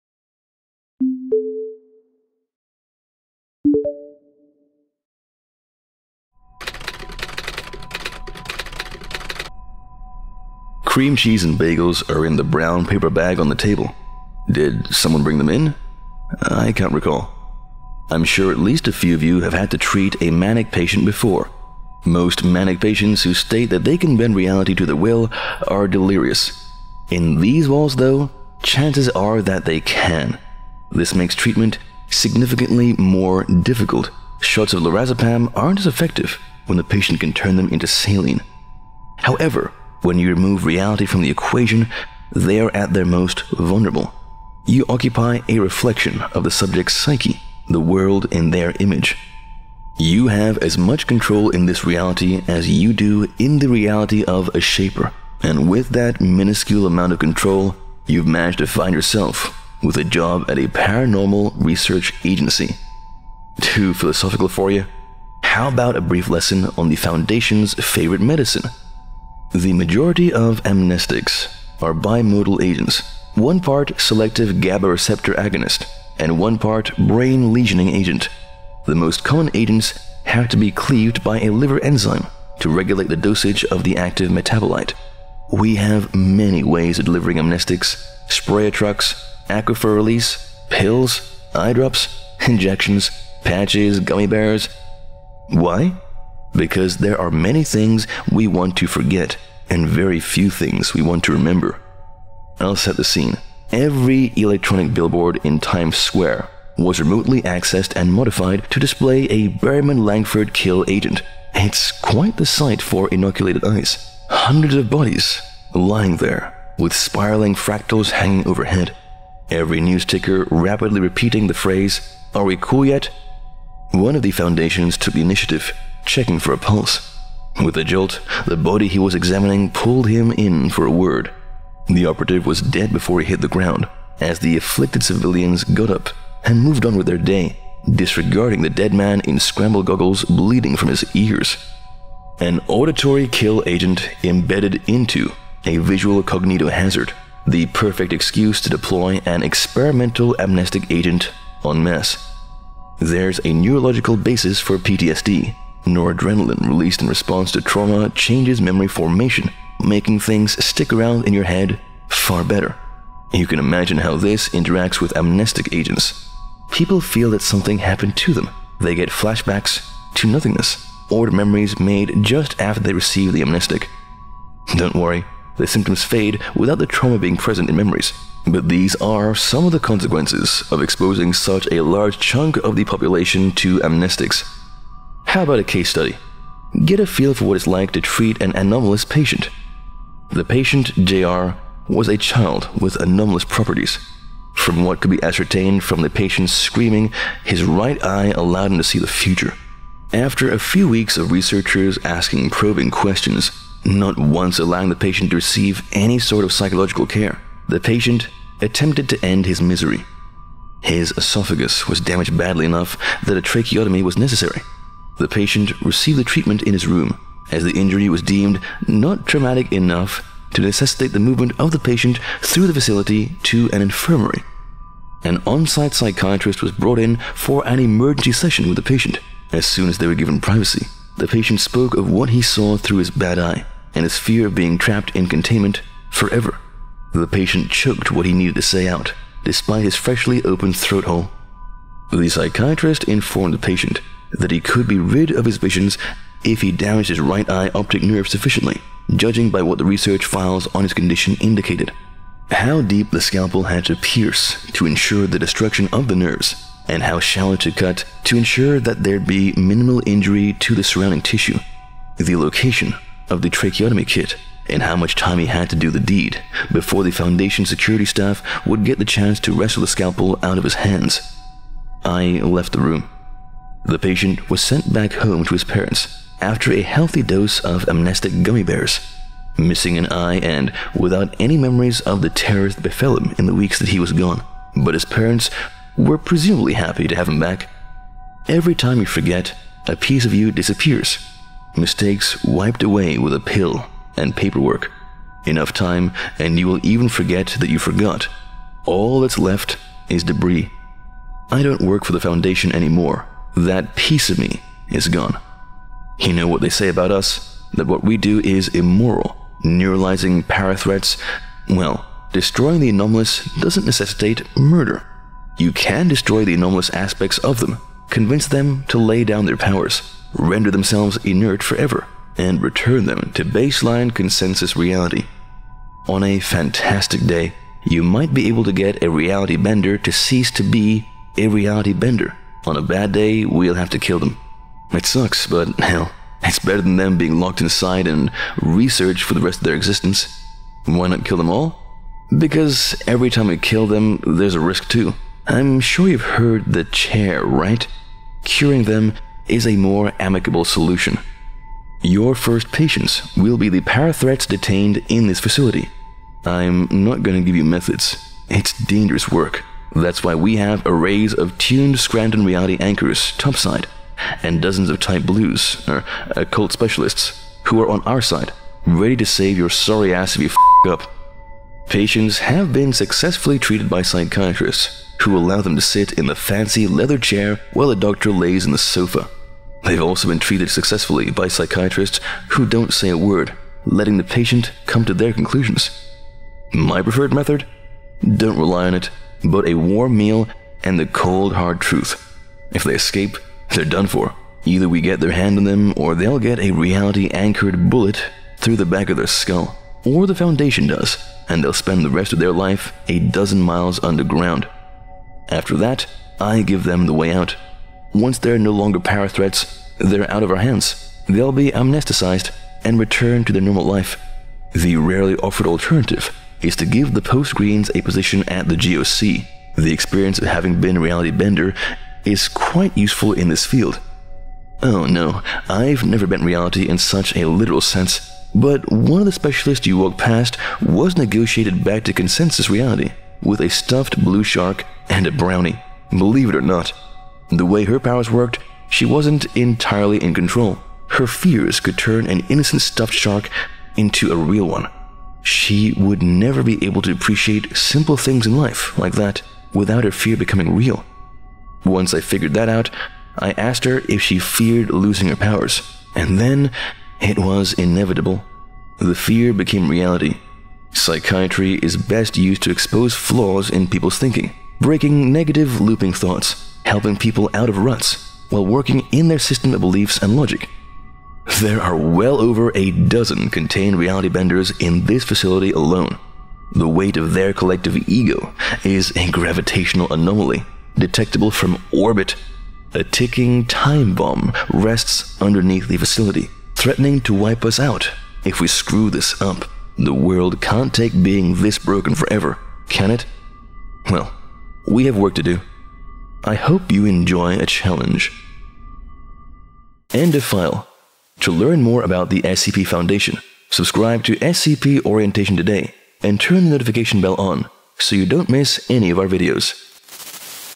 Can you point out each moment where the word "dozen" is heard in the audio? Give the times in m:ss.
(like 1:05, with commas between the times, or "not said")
6:04, 6:43, 7:52.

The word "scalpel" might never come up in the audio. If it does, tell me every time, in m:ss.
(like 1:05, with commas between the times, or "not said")
4:13, 4:29.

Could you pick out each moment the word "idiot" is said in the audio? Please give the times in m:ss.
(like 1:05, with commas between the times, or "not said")
not said.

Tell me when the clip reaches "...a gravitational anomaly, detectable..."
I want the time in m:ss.
7:59.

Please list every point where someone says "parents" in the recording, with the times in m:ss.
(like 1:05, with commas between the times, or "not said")
4:35, 4:45.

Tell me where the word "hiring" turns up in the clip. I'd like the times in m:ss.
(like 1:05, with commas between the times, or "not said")
not said.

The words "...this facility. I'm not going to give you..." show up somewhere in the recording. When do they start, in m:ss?
5:55.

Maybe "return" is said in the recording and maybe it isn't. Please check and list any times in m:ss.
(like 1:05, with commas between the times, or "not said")
5:22, 6:52.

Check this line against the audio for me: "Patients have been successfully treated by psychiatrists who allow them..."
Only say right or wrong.
right.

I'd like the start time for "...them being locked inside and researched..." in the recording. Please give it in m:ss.
5:36.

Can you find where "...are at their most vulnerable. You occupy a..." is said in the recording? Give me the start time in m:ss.
0:42.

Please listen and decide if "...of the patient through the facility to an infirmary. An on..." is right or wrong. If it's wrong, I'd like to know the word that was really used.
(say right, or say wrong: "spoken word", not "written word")
right.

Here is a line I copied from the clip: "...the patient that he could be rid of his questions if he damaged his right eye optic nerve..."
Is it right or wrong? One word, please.
wrong.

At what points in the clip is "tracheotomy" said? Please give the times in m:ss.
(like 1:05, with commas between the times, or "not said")
3:33, 4:23.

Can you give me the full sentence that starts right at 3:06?
Get a feel for what it's like to treat an anomalous patient.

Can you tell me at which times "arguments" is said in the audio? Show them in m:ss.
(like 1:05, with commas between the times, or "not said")
not said.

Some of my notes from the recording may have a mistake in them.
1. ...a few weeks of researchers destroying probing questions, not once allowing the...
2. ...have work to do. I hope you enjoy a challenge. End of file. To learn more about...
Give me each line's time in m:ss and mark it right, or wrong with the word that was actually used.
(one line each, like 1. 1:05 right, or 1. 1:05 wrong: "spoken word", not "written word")
1. 3:20 wrong: "asking", not "destroying"
2. 8:15 right.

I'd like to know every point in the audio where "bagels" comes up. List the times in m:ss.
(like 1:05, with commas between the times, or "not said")
0:11.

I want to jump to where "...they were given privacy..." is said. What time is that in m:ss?
3:49.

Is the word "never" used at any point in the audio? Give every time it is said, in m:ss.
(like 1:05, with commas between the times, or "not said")
7:06, 7:26.